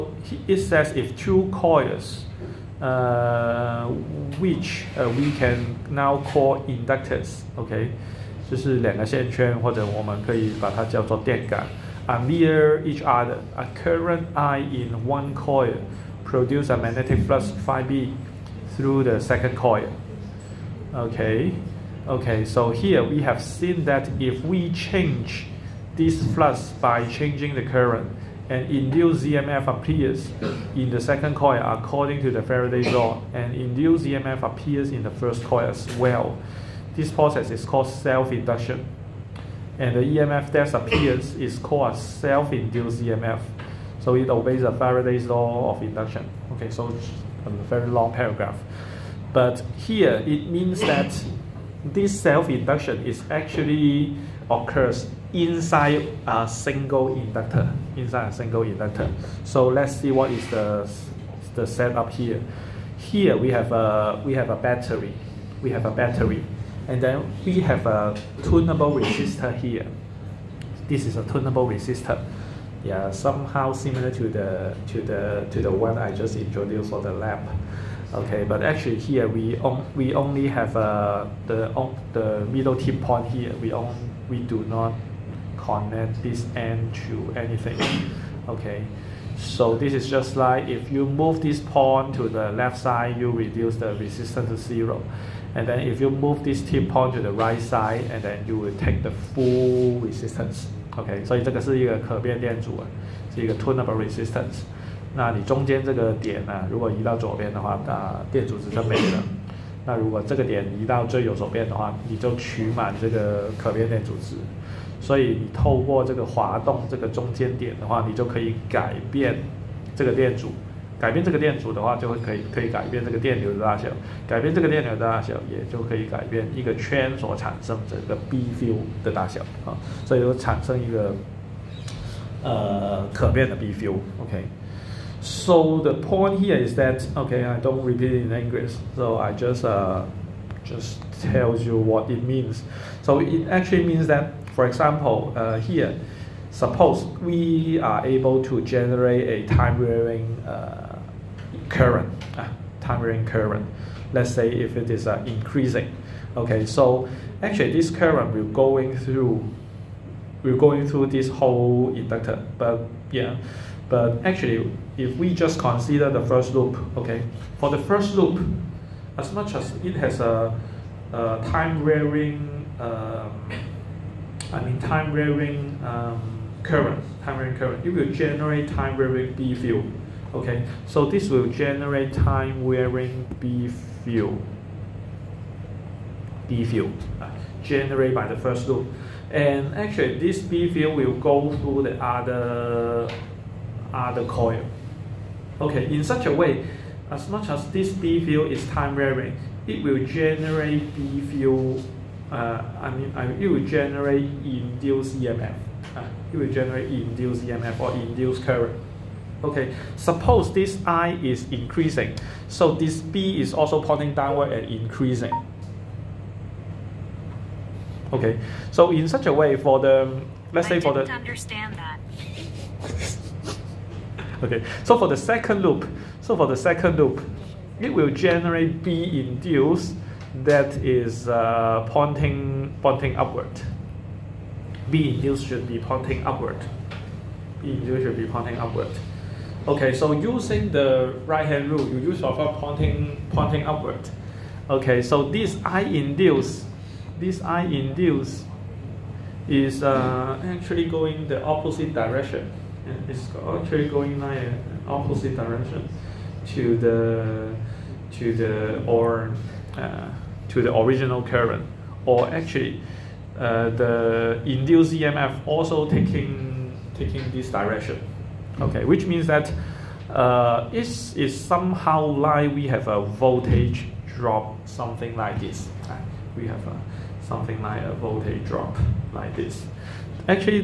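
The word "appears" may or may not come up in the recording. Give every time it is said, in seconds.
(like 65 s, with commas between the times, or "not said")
29 s, 34 s, 40 s.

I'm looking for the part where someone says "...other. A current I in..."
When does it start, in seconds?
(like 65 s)
13 s.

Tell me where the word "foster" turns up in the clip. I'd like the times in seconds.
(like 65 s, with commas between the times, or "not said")
not said.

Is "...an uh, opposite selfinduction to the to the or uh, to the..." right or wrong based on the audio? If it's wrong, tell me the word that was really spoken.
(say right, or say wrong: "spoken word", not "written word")
wrong: "direction", not "selfinduction".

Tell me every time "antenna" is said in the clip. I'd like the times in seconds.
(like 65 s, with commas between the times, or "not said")
not said.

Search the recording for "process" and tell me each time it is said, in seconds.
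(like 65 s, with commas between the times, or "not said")
37 s.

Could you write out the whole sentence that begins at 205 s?
Uh, it will generate induced EMF or induced current.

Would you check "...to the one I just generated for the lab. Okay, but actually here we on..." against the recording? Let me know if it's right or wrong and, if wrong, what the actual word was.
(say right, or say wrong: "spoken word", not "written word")
wrong: "introduced", not "generated".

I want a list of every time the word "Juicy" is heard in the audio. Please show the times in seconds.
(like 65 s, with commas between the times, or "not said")
not said.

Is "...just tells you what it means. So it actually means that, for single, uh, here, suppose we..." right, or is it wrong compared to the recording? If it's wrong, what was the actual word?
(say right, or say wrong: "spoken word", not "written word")
wrong: "example", not "single".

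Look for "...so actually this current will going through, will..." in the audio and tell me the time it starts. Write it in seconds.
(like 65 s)
156 s.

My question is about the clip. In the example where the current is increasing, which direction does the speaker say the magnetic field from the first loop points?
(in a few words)
downward.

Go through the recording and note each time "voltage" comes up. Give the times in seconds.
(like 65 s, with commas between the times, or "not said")
273 s, 277 s.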